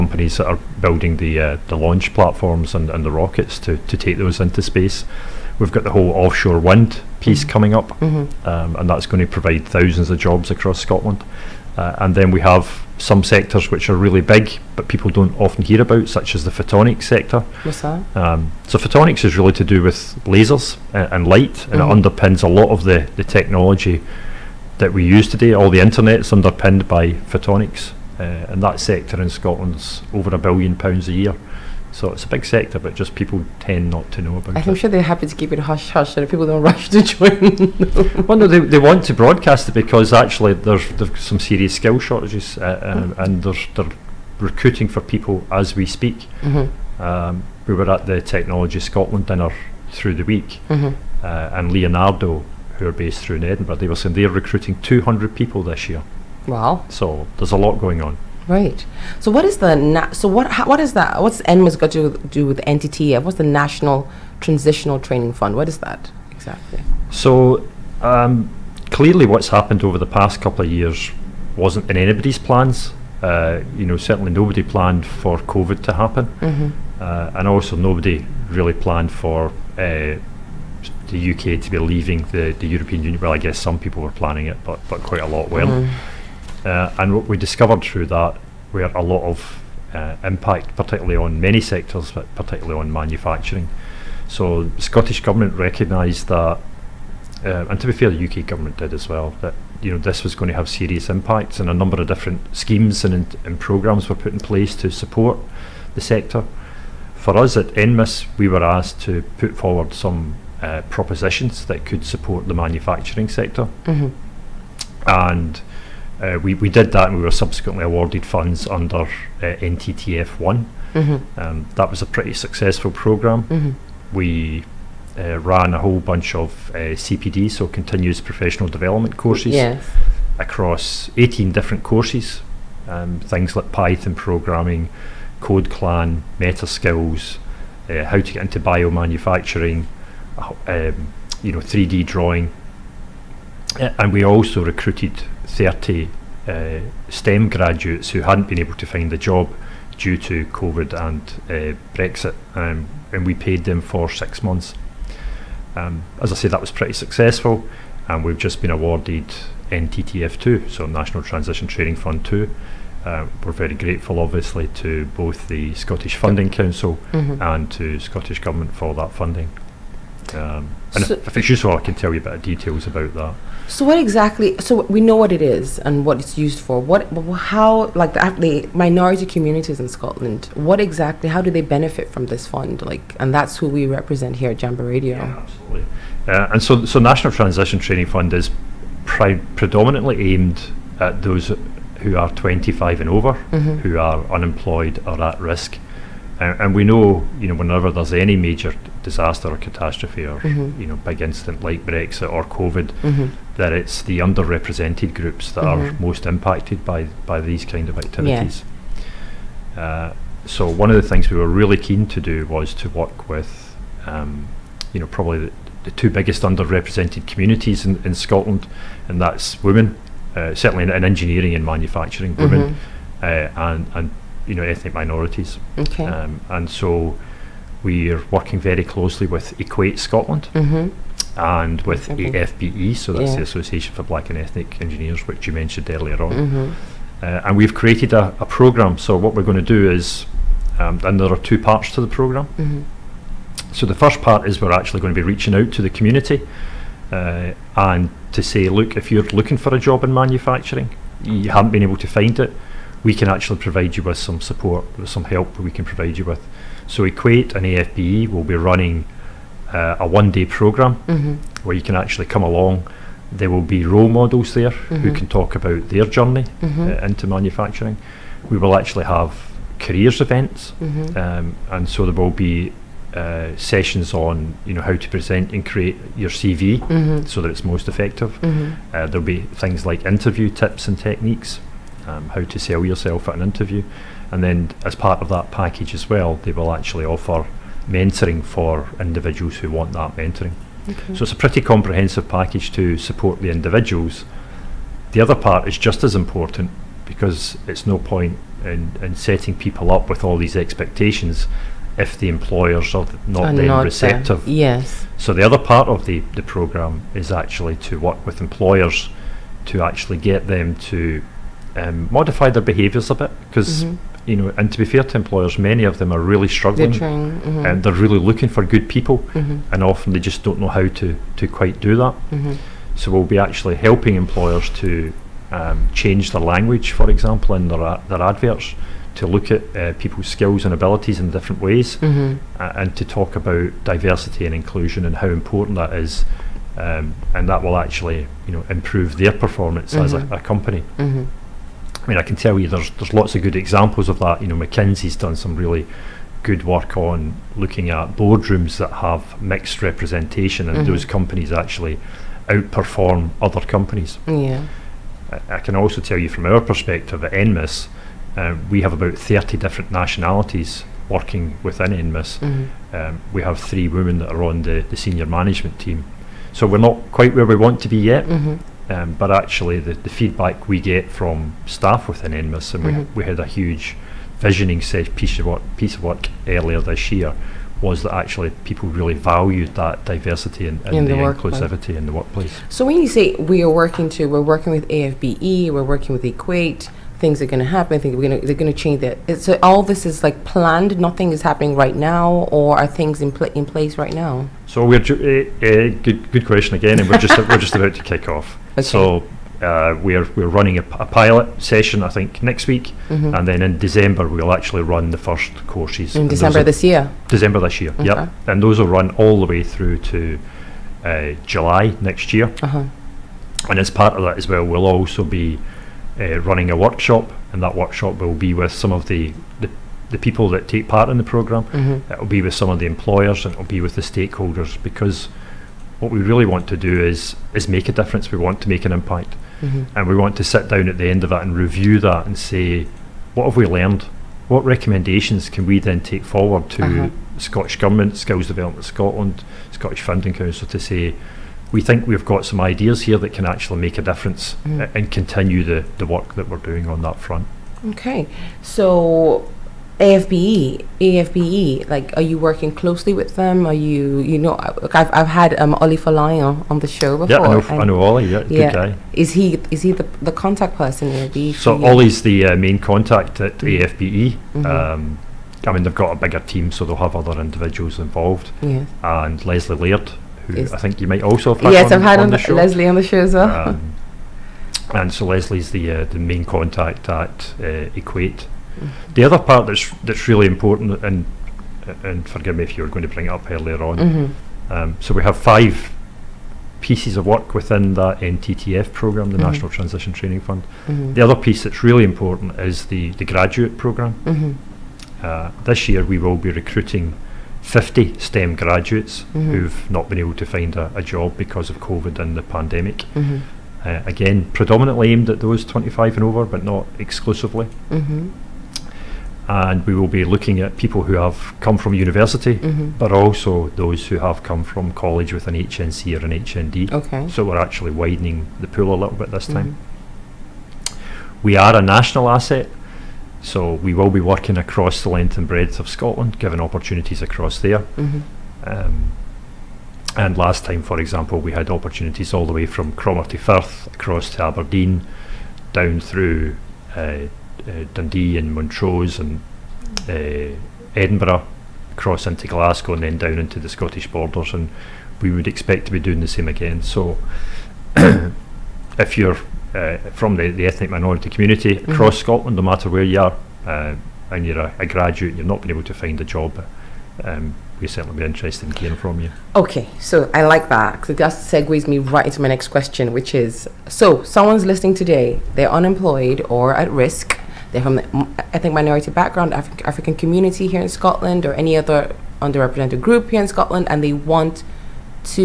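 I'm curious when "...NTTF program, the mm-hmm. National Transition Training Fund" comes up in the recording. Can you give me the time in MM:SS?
08:08.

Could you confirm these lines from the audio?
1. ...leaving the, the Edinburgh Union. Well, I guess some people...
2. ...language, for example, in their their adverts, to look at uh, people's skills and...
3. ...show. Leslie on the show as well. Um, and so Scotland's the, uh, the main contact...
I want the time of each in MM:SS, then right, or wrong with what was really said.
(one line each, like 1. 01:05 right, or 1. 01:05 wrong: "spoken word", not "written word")
1. 01:21 wrong: "European", not "Edinburgh"
2. 05:26 right
3. 07:52 wrong: "Leslie", not "Scotland".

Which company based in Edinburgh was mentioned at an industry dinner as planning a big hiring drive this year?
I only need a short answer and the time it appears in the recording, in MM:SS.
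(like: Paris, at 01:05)
Leonardo, at 00:51.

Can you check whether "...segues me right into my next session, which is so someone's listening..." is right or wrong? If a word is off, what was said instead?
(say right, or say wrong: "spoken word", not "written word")
wrong: "question", not "session".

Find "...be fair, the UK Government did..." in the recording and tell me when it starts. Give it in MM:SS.
01:37.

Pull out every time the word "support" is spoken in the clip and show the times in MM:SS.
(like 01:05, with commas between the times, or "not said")
01:44, 01:52, 04:14, 04:52.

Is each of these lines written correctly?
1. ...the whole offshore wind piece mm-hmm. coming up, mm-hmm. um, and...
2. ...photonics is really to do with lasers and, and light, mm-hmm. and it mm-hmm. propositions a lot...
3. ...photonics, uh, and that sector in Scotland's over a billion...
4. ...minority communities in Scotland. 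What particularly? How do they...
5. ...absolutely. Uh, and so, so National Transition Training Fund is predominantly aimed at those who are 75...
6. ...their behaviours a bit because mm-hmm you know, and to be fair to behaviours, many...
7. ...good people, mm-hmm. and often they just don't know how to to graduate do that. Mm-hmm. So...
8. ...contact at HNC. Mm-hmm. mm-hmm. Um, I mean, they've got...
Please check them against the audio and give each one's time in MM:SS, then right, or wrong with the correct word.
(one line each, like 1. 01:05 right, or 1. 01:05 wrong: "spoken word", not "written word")
1. 00:05 right
2. 00:18 wrong: "underpins", not "propositions"
3. 00:27 right
4. 02:58 wrong: "exactly", not "particularly"
5. 03:05 wrong: "25", not "75"
6. 05:12 wrong: "employers", not "behaviours"
7. 05:18 wrong: "quite", not "graduate"
8. 07:42 wrong: "AFBE", not "HNC".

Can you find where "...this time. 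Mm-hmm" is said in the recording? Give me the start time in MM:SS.
08:39.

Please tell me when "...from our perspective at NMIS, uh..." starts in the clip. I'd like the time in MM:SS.
05:56.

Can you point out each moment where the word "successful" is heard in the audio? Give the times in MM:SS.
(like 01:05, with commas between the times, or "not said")
02:02, 02:36.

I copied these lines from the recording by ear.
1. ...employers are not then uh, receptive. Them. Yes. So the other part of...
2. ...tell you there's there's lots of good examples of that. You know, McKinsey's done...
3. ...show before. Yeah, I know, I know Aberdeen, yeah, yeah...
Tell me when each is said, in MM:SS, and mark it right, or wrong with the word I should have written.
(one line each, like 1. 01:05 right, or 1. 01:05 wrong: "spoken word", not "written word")
1. 05:02 right
2. 05:42 right
3. 07:36 wrong: "Ollie", not "Aberdeen".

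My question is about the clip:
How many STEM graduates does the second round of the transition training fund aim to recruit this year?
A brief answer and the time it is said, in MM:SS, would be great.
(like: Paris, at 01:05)
50, at 08:17.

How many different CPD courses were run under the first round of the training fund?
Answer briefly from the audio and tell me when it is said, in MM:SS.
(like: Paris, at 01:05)
18, at 02:11.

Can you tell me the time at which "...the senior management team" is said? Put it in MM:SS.
06:04.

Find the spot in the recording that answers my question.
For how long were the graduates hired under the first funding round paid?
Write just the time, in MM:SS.
02:34.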